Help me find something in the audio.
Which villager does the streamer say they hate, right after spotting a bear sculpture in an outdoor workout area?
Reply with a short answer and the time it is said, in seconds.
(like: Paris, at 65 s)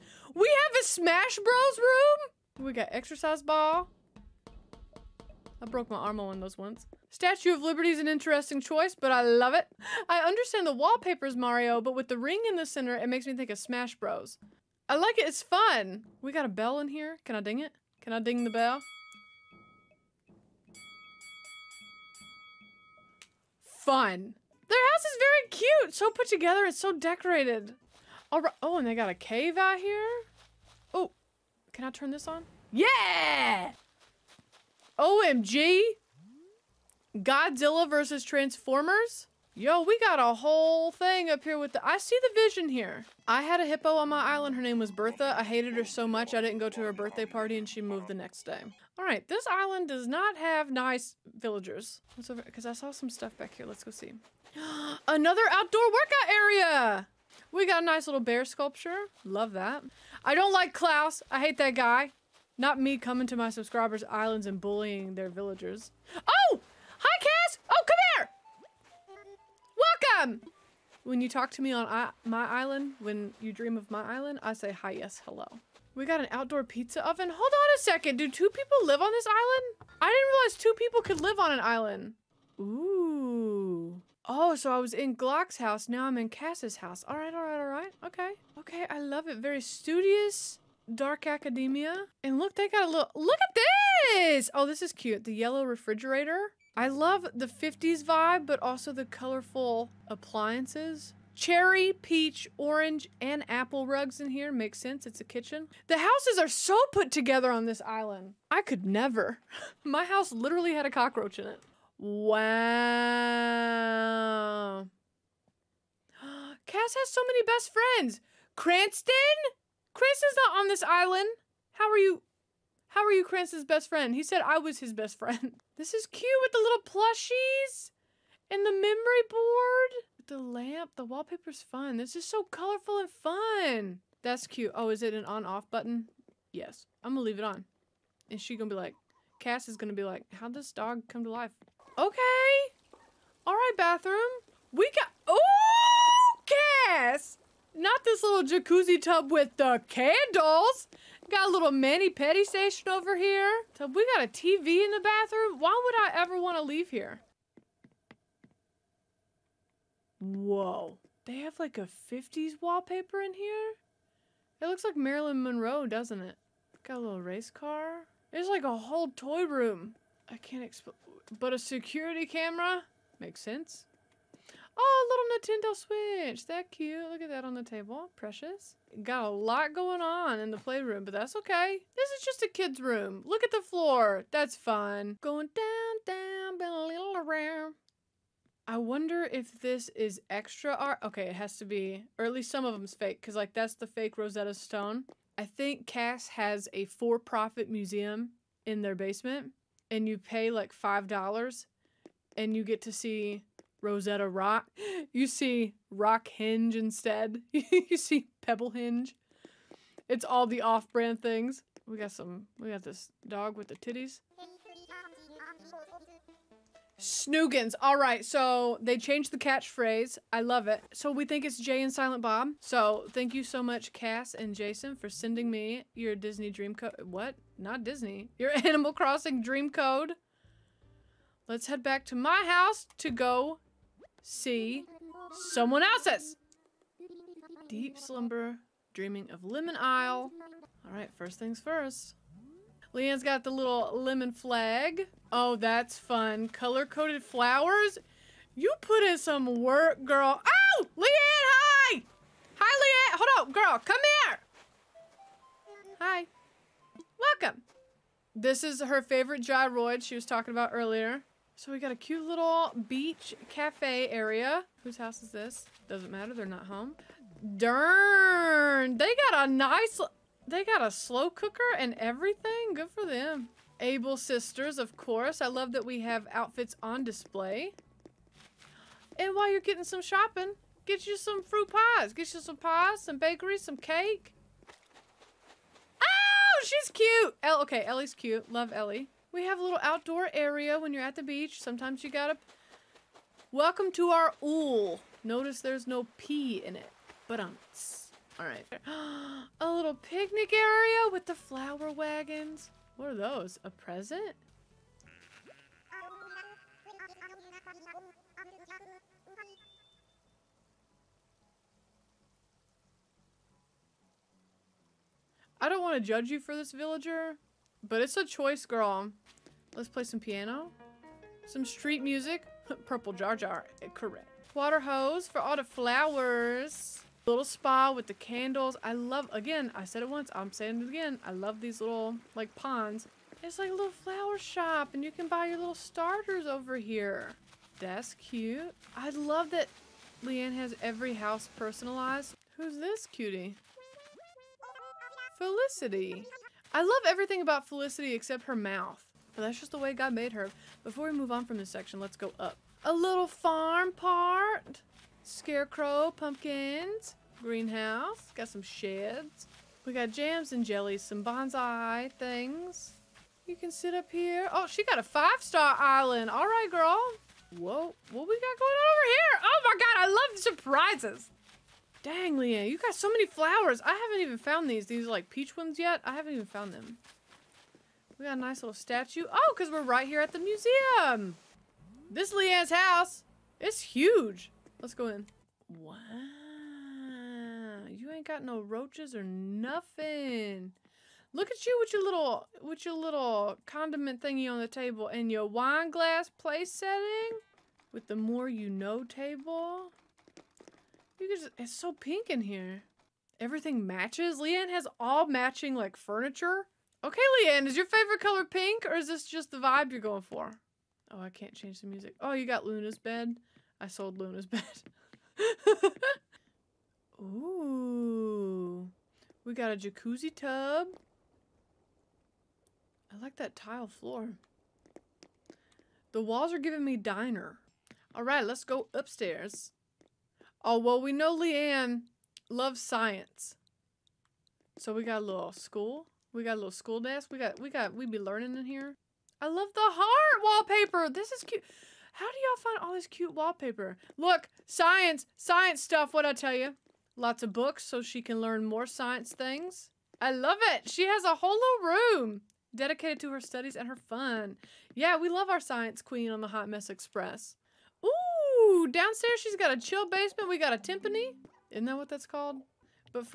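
Klaus, at 60 s.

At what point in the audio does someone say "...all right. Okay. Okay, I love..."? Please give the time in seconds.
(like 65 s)
87 s.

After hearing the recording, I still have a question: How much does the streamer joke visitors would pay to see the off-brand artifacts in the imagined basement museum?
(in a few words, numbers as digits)
5 dollars.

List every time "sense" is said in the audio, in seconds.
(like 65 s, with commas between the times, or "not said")
104 s, 173 s.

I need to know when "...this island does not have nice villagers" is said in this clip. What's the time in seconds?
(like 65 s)
49 s.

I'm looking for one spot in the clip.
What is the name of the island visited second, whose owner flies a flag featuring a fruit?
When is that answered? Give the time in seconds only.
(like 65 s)
239 s.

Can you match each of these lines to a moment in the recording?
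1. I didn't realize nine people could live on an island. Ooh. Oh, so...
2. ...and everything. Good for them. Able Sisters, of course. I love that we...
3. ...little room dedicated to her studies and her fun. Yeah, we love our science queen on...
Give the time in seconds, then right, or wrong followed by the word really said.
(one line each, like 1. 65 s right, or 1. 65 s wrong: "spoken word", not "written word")
1. 79 s wrong: "two", not "nine"
2. 271 s right
3. 451 s right.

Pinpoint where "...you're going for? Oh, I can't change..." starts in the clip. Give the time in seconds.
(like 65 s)
409 s.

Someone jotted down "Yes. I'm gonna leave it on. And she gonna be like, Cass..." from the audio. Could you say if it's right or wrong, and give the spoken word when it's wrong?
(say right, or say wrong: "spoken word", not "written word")
right.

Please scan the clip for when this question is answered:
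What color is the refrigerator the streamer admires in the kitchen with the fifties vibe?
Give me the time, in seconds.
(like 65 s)
95 s.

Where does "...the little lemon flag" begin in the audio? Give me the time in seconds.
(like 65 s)
243 s.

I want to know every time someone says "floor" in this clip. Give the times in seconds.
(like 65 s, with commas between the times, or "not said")
183 s, 423 s.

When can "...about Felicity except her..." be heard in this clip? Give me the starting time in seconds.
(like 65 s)
347 s.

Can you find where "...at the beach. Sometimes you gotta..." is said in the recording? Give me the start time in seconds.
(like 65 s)
291 s.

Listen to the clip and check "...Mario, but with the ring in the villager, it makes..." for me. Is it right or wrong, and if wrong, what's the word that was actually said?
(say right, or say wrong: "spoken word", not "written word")
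wrong: "center", not "villager".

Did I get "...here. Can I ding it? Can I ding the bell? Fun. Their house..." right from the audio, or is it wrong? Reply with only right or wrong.
right.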